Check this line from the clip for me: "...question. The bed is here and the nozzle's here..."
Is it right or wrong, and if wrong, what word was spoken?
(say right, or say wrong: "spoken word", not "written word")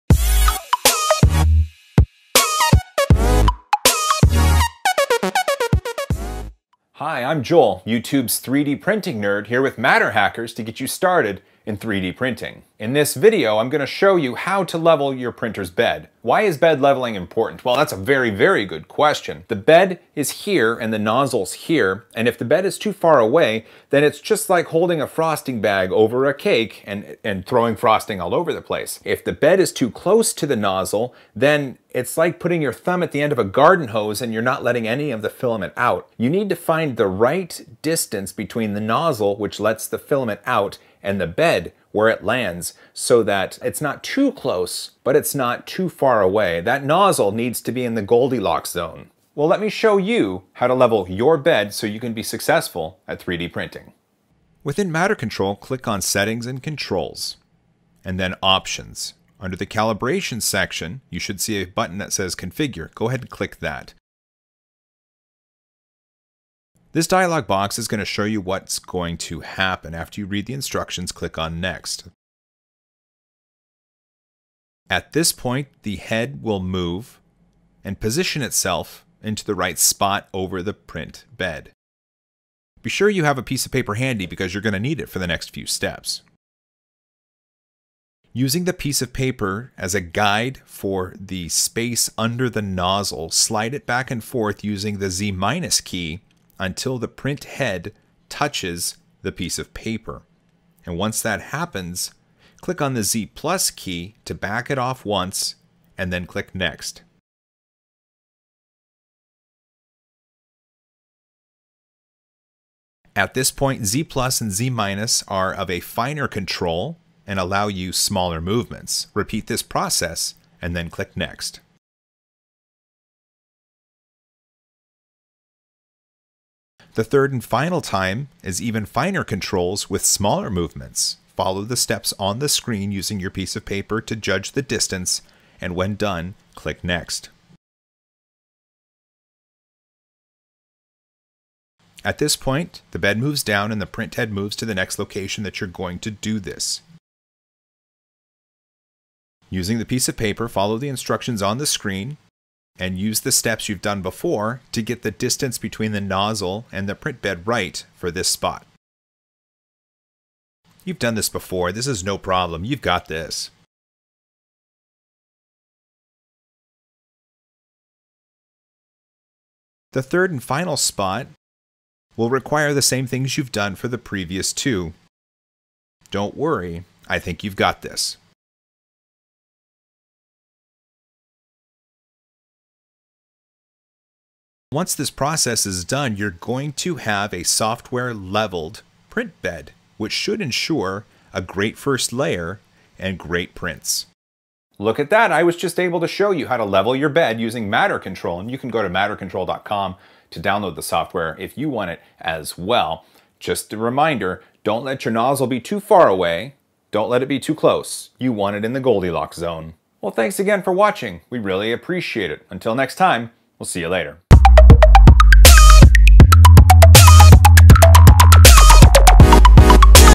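right.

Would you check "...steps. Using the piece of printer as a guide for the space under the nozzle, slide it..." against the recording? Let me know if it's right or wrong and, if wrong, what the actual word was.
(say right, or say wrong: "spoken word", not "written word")
wrong: "paper", not "printer".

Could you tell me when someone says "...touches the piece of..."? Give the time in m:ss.
1:38.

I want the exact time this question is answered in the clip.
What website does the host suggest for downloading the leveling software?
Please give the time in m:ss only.
3:18.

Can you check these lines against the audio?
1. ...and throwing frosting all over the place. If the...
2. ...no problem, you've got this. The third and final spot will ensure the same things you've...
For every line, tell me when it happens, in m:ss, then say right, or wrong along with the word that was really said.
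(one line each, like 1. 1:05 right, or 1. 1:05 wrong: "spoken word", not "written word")
1. 0:27 right
2. 2:42 wrong: "require", not "ensure".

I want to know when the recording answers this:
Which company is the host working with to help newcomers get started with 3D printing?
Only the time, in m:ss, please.
0:09.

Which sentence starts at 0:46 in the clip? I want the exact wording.
That nozzle needs to be in the Goldilocks zone.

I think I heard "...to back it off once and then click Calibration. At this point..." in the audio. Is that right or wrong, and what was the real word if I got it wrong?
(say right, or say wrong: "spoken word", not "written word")
wrong: "Next", not "Calibration".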